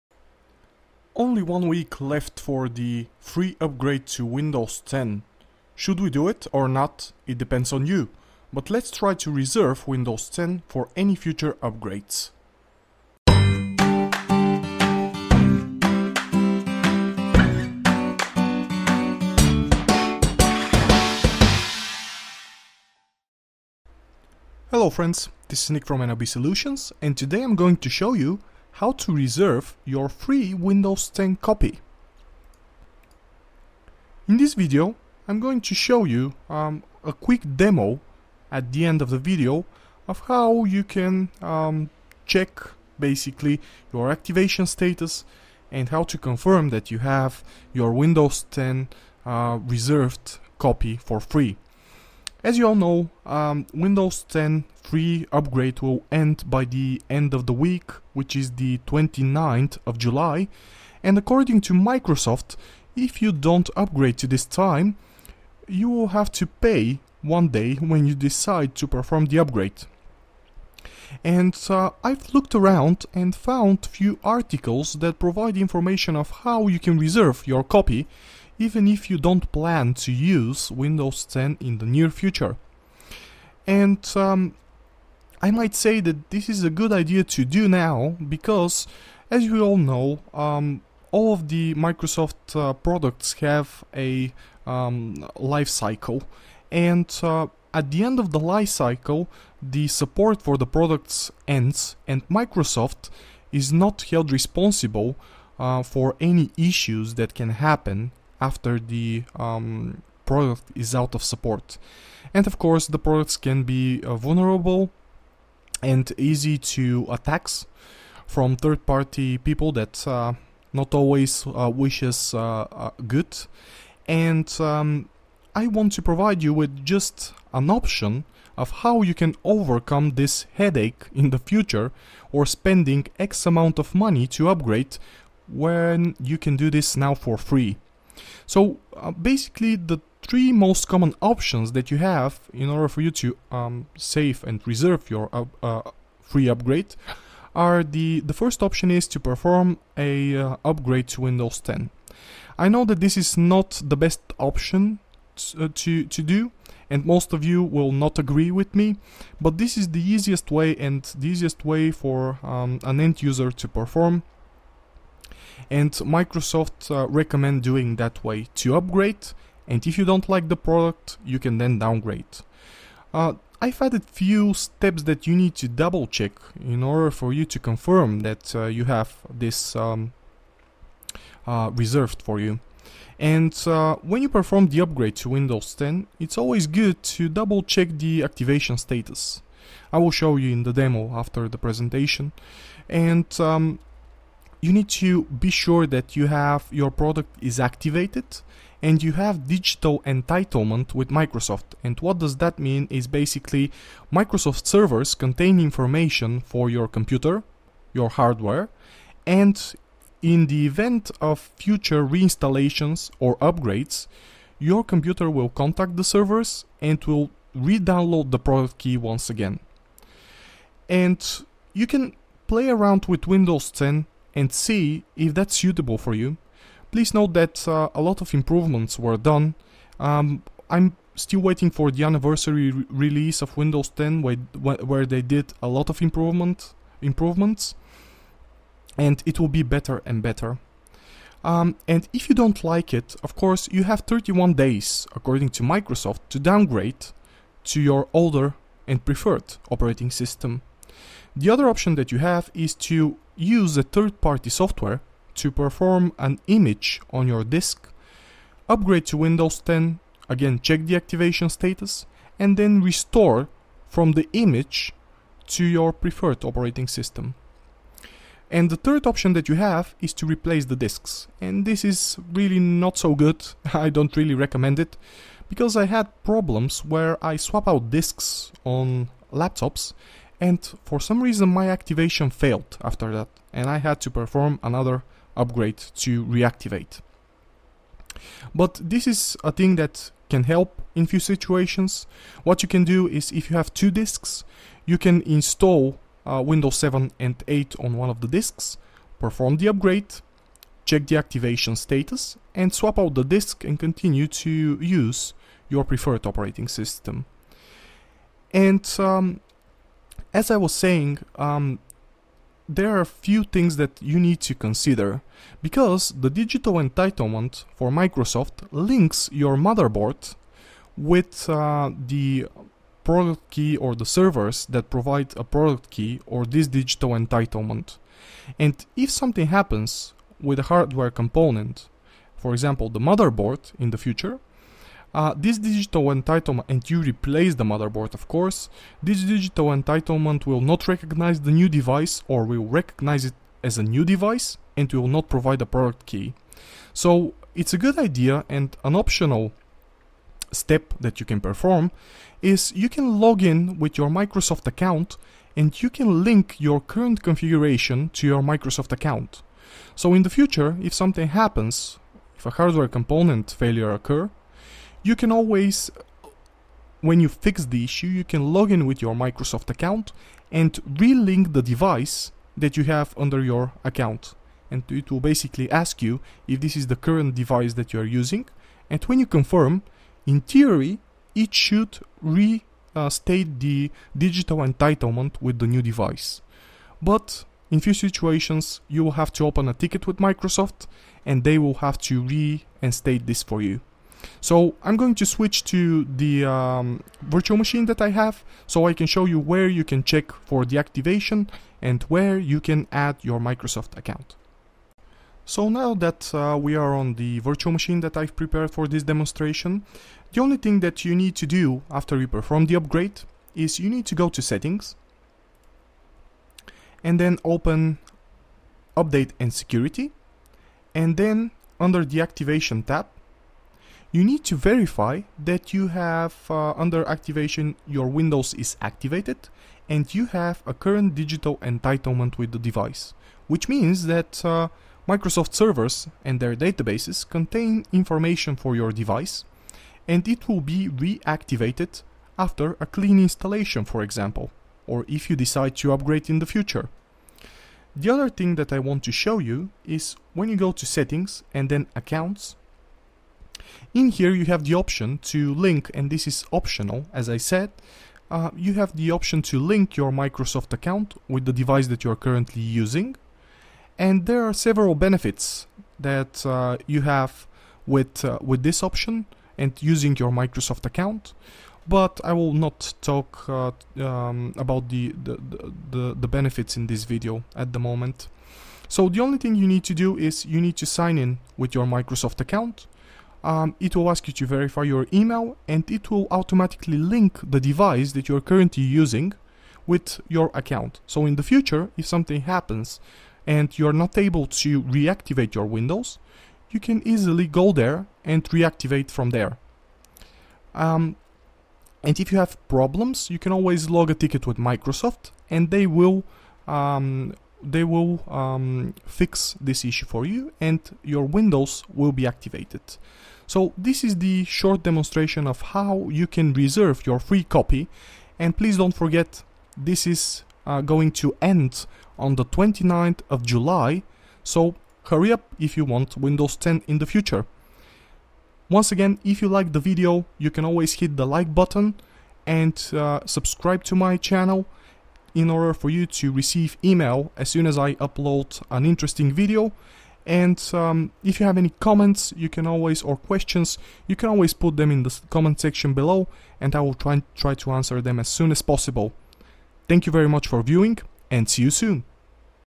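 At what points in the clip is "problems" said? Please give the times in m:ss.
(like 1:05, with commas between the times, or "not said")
4:36, 8:22.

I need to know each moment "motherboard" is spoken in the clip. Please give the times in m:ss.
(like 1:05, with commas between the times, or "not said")
5:19, 5:32, 5:37.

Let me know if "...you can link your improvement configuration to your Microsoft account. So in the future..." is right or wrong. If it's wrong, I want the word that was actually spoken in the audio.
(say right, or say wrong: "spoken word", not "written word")
wrong: "current", not "improvement".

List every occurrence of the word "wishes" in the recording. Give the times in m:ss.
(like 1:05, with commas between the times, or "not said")
2:01.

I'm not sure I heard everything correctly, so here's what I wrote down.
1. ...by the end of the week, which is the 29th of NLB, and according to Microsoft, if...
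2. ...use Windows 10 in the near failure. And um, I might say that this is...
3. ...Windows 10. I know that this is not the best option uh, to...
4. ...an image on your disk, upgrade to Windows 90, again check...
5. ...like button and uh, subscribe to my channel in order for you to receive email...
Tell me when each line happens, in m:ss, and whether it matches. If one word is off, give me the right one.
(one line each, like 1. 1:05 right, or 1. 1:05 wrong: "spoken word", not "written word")
1. 0:56 wrong: "July", not "NLB"
2. 1:20 wrong: "future", not "failure"
3. 2:31 right
4. 4:16 wrong: "10", not "90"
5. 8:51 right.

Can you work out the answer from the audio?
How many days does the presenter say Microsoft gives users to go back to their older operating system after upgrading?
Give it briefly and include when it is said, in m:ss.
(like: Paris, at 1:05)
31, at 4:04.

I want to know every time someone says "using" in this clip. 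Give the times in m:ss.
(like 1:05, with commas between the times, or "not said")
6:18, 7:42, 7:49, 8:08.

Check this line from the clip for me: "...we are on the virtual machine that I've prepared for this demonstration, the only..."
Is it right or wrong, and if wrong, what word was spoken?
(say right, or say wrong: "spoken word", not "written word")
right.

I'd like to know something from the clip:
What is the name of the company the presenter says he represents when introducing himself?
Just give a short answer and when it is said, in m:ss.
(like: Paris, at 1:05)
NLB Solutions, at 0:26.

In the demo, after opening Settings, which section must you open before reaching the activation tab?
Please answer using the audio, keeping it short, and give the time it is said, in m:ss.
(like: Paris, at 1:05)
Update and security, at 6:58.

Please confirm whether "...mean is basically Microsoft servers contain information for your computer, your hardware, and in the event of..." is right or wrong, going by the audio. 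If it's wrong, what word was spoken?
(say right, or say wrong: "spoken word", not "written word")
right.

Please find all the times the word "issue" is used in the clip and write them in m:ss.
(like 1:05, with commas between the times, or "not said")
1:46, 6:07, 8:29.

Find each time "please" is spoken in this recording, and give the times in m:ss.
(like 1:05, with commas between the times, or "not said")
3:46, 8:38.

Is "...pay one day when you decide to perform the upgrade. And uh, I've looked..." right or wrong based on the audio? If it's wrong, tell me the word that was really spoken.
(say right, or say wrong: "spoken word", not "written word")
right.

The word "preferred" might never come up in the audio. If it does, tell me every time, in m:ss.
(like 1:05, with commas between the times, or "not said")
4:09, 4:25, 5:05.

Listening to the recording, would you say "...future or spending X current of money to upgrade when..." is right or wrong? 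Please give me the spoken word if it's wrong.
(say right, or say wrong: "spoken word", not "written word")
wrong: "amount", not "current".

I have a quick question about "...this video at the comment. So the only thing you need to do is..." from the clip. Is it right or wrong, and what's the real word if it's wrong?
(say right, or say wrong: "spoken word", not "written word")
wrong: "moment", not "comment".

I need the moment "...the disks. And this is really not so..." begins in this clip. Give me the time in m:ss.
4:30.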